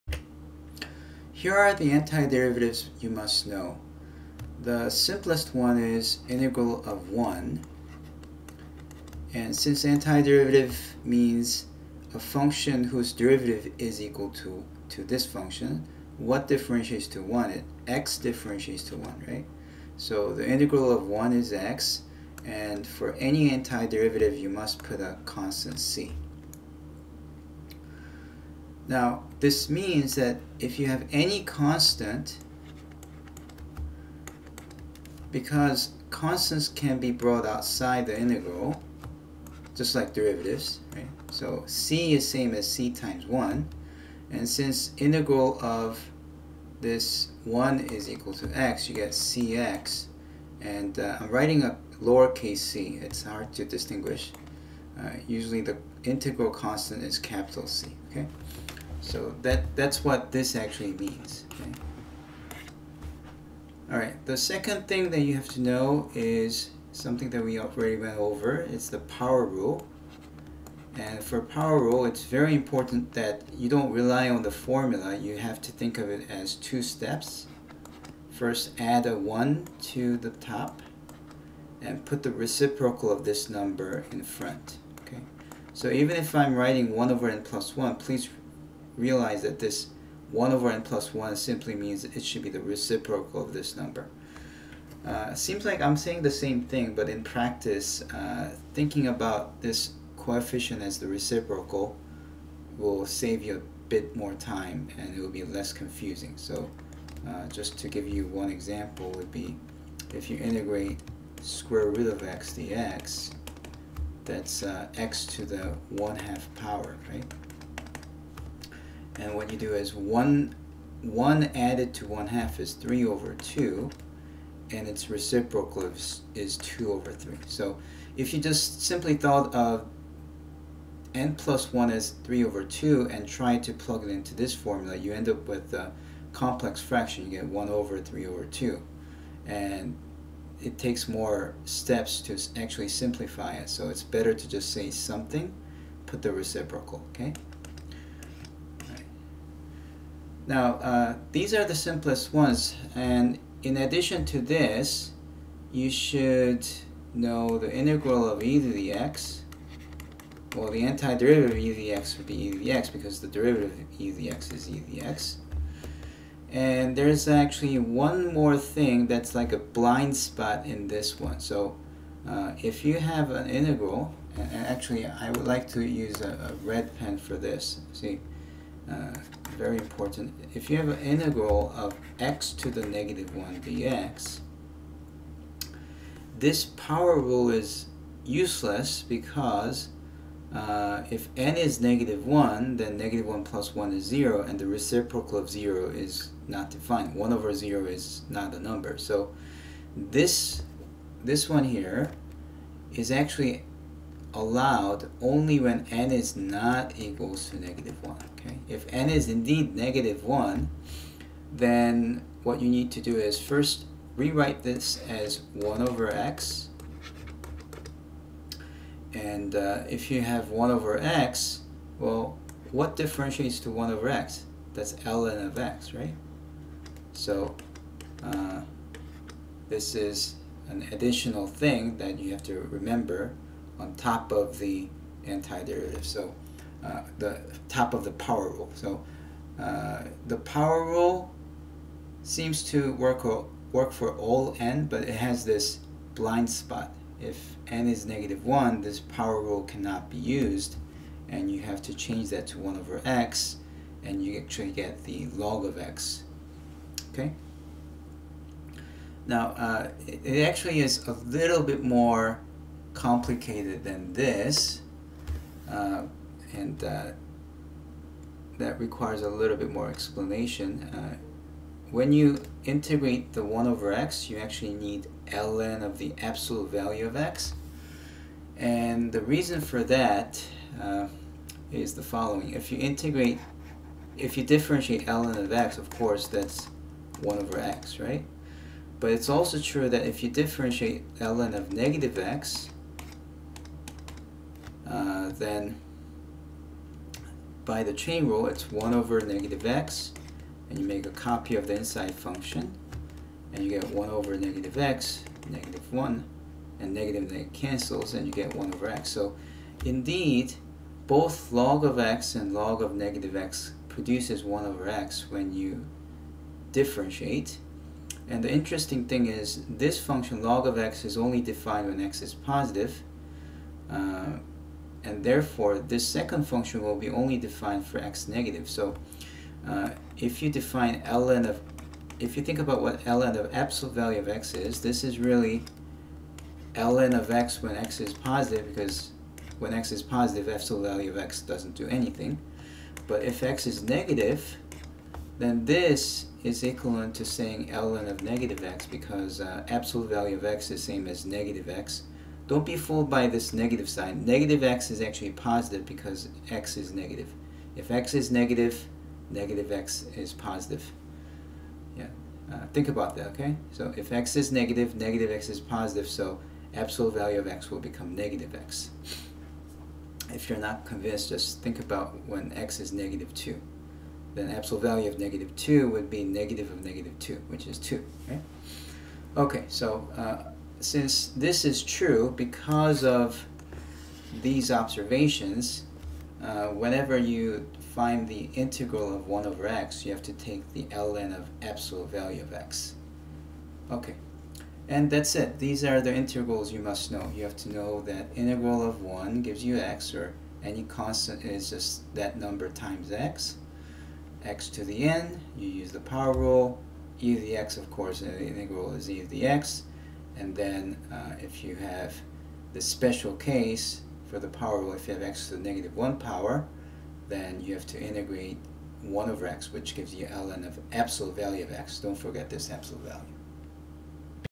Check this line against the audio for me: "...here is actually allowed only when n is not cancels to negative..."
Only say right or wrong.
wrong.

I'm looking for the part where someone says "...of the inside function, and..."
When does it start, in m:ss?
5:01.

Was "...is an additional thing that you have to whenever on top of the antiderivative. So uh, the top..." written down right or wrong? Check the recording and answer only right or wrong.
wrong.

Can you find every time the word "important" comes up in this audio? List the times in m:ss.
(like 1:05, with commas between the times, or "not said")
1:12, 2:59.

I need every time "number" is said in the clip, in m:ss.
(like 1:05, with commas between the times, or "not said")
1:23, 1:33, 3:18, 6:42.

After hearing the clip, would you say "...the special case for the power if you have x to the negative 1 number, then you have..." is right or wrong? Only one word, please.
wrong.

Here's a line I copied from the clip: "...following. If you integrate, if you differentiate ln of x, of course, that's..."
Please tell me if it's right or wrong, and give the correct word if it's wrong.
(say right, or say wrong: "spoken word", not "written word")
right.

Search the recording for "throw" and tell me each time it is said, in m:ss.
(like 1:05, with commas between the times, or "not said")
not said.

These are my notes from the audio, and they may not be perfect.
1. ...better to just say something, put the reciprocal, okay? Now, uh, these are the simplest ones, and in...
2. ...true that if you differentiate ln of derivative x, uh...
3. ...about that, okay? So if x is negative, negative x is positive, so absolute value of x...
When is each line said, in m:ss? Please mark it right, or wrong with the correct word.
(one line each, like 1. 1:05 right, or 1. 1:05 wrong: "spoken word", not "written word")
1. 2:24 right
2. 4:49 wrong: "negative", not "derivative"
3. 6:02 right.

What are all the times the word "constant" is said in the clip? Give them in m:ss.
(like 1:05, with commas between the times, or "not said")
0:25, 0:31, 0:36, 0:56, 6:40.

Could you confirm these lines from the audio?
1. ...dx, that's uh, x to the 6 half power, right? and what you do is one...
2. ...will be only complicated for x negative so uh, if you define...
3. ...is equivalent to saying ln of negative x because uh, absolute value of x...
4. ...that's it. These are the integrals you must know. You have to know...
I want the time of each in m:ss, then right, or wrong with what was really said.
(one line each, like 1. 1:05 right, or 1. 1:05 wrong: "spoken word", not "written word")
1. 1:52 wrong: "1", not "6"
2. 5:26 wrong: "defined", not "complicated"
3. 5:46 right
4. 6:35 right.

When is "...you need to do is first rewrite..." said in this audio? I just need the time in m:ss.
3:32.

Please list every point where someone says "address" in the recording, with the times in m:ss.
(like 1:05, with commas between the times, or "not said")
not said.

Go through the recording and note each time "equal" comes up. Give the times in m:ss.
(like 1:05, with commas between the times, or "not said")
0:13, 0:48, 3:26.